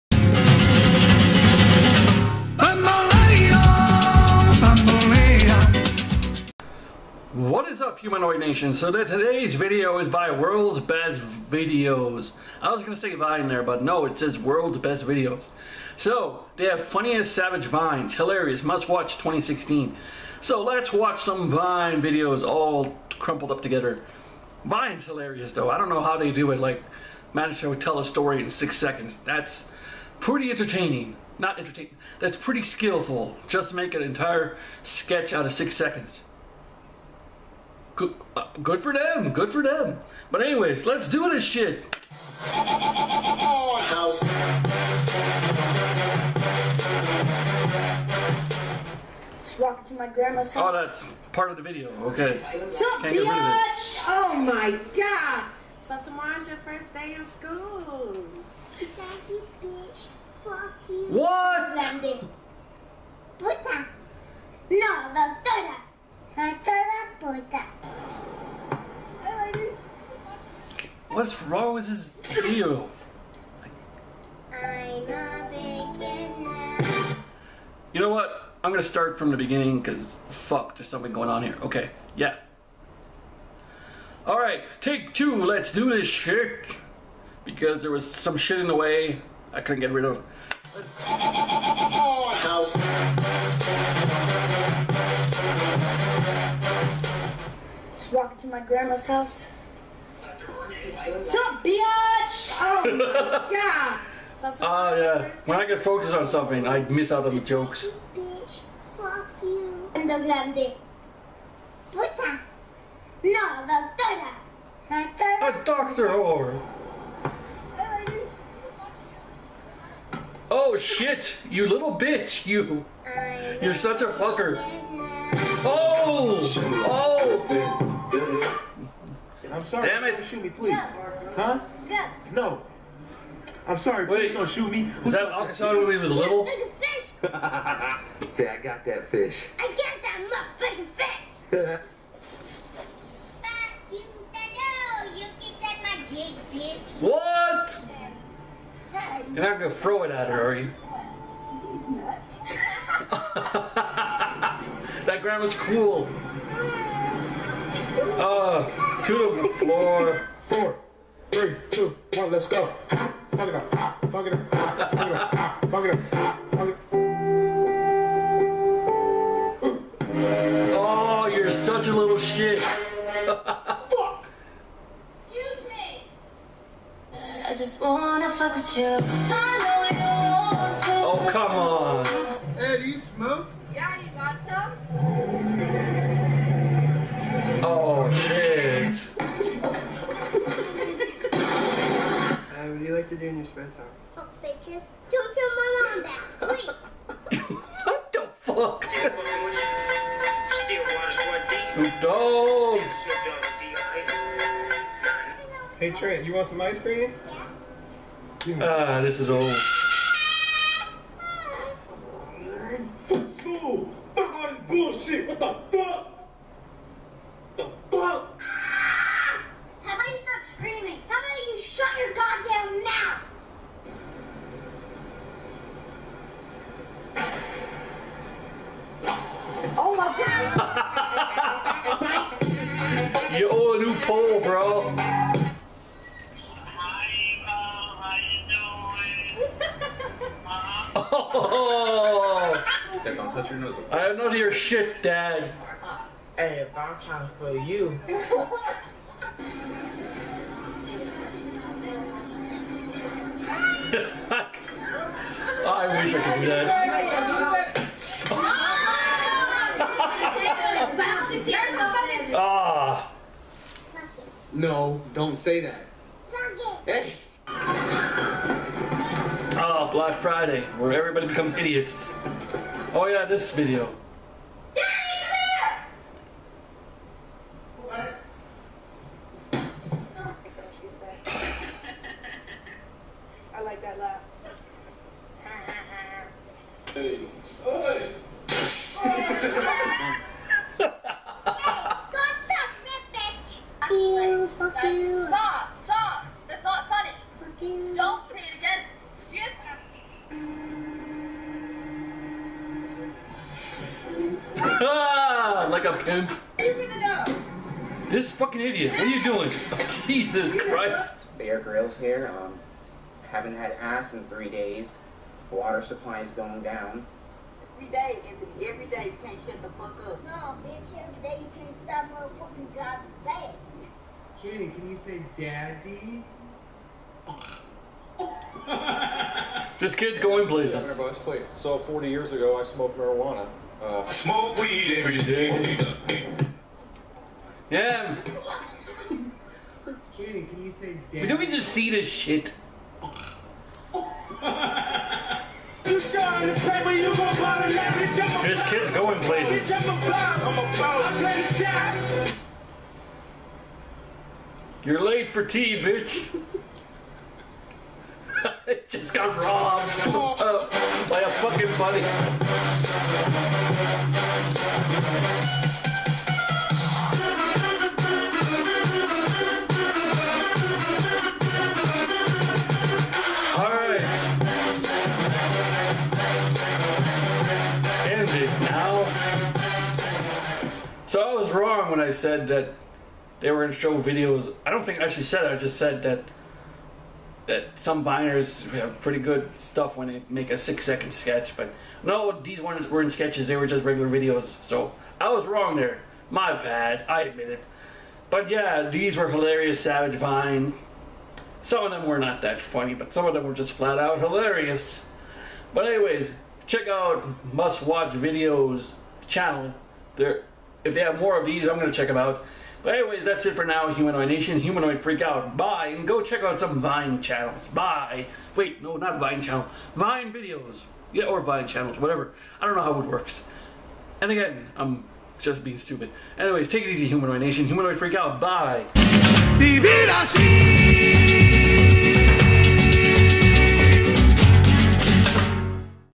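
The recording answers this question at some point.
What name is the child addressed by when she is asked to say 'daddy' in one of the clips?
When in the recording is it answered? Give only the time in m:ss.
5:24.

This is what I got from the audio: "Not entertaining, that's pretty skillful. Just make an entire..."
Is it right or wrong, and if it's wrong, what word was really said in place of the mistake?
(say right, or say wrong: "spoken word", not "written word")
right.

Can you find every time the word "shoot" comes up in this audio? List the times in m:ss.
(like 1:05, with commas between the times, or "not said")
2:10, 2:14.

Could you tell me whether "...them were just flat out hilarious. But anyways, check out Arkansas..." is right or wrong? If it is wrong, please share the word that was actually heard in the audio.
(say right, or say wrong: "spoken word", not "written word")
wrong: "Must", not "Arkansas".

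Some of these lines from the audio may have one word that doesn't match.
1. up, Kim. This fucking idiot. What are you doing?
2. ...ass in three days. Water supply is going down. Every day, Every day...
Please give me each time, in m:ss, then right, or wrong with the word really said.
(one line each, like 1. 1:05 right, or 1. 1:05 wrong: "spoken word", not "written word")
1. 5:05 right
2. 5:13 right.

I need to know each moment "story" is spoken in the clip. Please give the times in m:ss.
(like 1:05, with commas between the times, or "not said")
0:28.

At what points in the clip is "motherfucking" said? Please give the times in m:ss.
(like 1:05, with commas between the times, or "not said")
2:20, 5:22.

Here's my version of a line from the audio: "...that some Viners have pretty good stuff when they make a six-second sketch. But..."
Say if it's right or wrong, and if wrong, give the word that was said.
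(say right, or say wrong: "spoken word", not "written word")
right.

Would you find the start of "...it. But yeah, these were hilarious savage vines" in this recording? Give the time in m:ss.
6:37.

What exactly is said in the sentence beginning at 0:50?
Oh, that's part of the video.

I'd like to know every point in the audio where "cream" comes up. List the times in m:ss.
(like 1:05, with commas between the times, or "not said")
3:26.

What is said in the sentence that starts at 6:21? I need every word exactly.
was wrong when I said that they were going to show videos.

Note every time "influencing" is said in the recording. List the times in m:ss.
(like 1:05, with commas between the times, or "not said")
not said.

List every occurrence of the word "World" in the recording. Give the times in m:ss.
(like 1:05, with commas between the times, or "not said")
0:10, 0:14.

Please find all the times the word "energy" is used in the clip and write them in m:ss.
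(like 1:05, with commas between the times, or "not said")
not said.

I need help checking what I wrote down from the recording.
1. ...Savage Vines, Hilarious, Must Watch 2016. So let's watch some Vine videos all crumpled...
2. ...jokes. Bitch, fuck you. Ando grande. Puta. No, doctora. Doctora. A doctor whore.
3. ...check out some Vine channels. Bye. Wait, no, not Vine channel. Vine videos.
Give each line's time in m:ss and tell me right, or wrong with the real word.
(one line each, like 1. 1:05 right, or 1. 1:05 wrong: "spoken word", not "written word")
1. 0:17 right
2. 1:47 right
3. 6:56 right.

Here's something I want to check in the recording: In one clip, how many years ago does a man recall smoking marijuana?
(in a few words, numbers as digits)
40.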